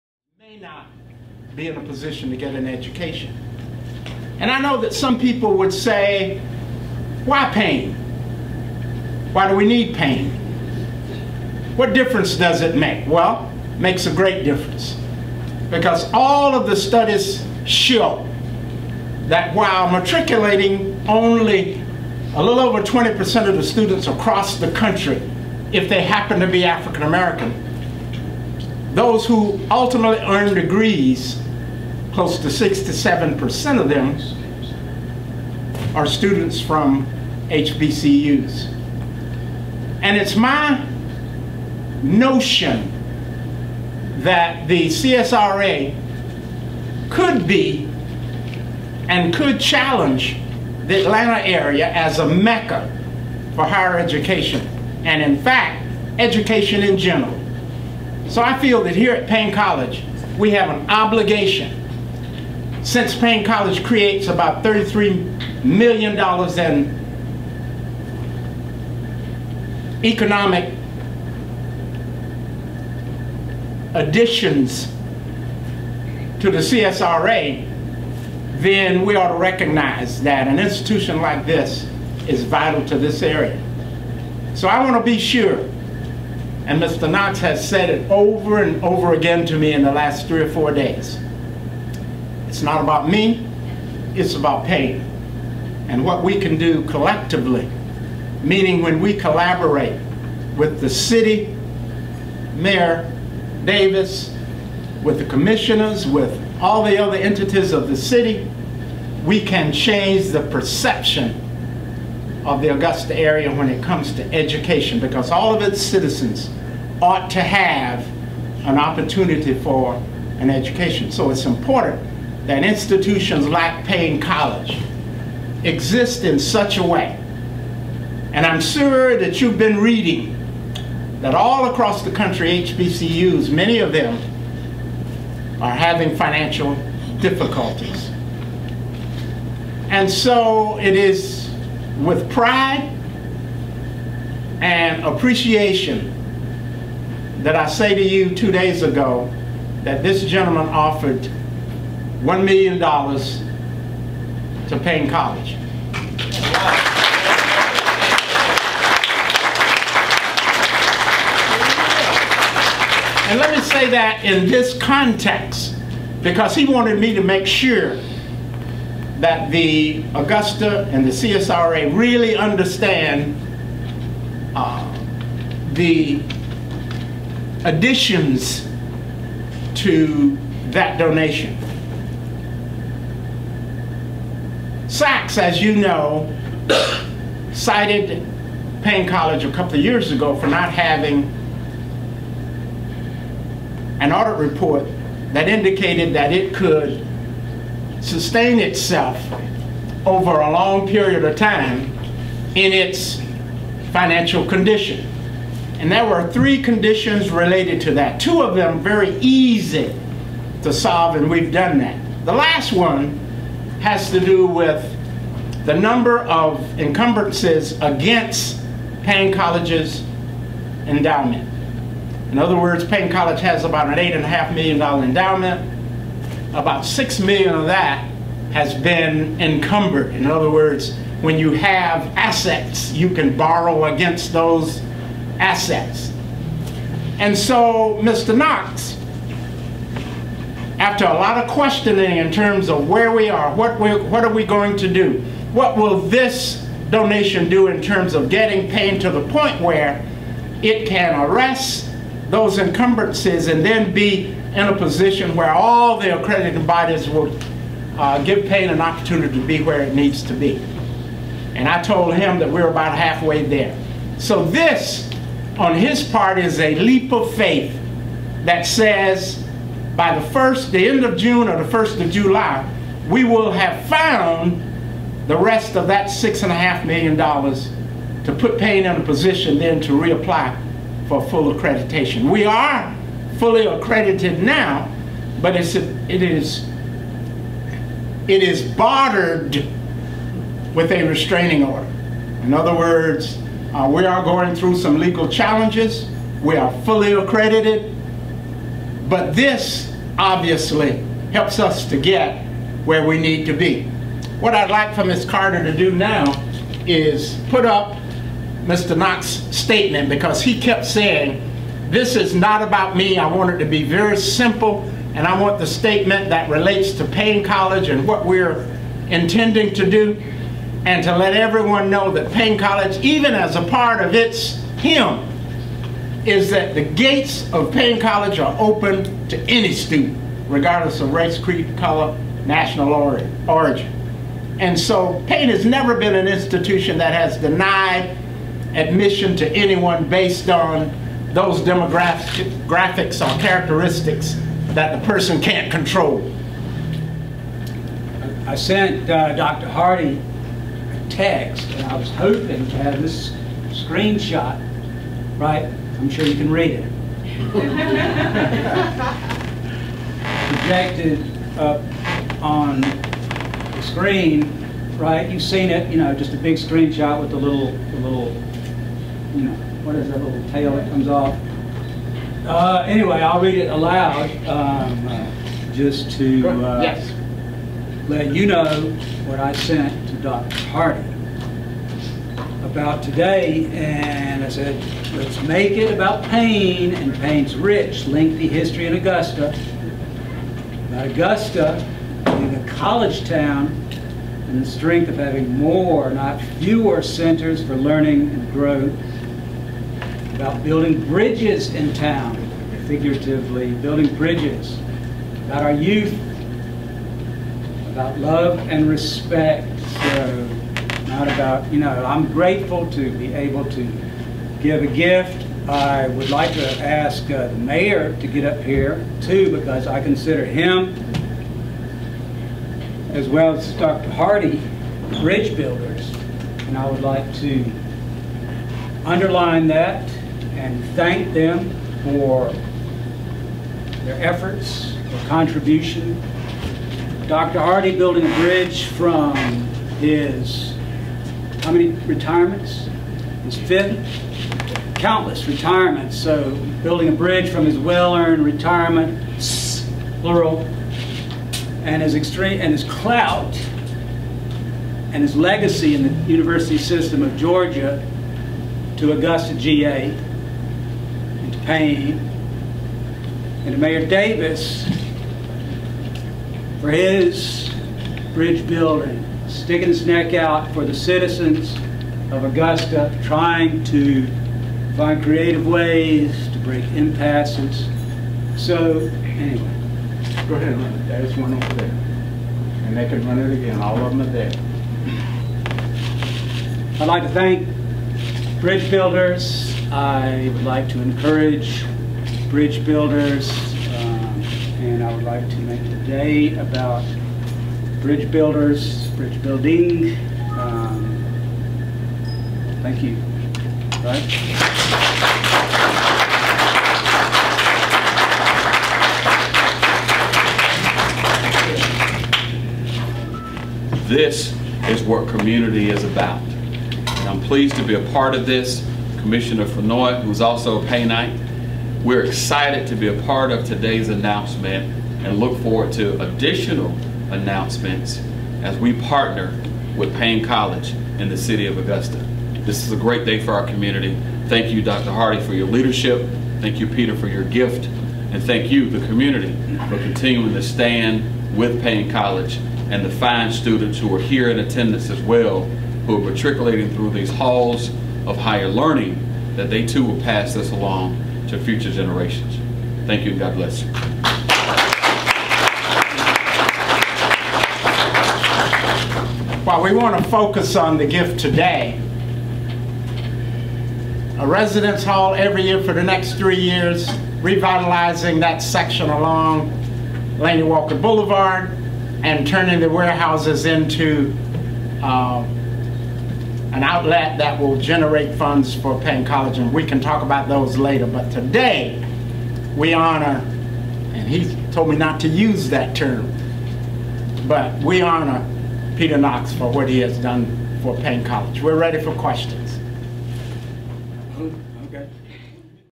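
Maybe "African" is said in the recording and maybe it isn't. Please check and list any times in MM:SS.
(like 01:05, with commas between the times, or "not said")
00:26.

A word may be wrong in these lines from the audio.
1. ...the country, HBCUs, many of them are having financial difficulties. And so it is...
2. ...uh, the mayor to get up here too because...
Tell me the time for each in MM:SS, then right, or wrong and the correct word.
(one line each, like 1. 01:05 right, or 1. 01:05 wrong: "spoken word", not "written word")
1. 02:12 right
2. 06:57 right.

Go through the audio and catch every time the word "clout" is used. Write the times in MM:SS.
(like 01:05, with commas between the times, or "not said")
07:32.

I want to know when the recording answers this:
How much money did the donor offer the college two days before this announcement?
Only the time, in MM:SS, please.
02:32.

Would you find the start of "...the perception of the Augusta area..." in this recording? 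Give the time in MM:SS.
01:50.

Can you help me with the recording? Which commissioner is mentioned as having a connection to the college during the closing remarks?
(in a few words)
Commissioner Fennoy.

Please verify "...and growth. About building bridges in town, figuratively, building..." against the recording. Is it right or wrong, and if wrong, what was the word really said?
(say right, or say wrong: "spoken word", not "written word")
right.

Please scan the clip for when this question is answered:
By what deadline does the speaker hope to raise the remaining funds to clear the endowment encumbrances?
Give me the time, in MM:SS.
04:31.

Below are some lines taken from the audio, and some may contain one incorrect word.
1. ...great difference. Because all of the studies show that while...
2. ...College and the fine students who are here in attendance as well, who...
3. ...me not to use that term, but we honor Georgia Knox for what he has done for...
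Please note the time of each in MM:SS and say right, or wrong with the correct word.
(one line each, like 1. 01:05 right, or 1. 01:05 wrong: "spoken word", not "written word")
1. 00:14 right
2. 09:02 right
3. 09:44 wrong: "Peter", not "Georgia".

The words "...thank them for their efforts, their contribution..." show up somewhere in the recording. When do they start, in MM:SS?
07:10.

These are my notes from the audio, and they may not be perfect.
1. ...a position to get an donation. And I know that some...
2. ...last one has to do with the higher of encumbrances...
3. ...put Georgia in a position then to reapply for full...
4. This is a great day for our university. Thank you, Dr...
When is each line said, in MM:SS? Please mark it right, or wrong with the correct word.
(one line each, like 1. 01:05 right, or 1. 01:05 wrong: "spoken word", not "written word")
1. 00:01 wrong: "education", not "donation"
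2. 03:32 wrong: "number", not "higher"
3. 04:38 wrong: "Paine", not "Georgia"
4. 08:52 wrong: "community", not "university".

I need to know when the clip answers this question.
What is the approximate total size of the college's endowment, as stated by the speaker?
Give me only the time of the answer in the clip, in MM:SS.
03:43.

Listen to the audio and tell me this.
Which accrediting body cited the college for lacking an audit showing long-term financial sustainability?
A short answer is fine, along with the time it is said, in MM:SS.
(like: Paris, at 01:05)
SACS, at 03:04.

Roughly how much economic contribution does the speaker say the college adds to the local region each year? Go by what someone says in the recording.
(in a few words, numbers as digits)
$33 million.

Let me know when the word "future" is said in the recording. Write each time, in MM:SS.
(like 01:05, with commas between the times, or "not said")
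09:11.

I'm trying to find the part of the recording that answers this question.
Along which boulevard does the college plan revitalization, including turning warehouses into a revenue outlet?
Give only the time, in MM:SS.
09:30.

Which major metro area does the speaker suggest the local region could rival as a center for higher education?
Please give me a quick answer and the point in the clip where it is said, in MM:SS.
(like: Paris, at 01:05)
Atlanta, at 00:51.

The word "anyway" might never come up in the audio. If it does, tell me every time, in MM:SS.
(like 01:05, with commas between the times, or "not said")
06:12, 07:59.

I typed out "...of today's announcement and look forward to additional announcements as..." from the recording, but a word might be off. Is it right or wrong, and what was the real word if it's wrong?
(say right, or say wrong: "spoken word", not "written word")
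right.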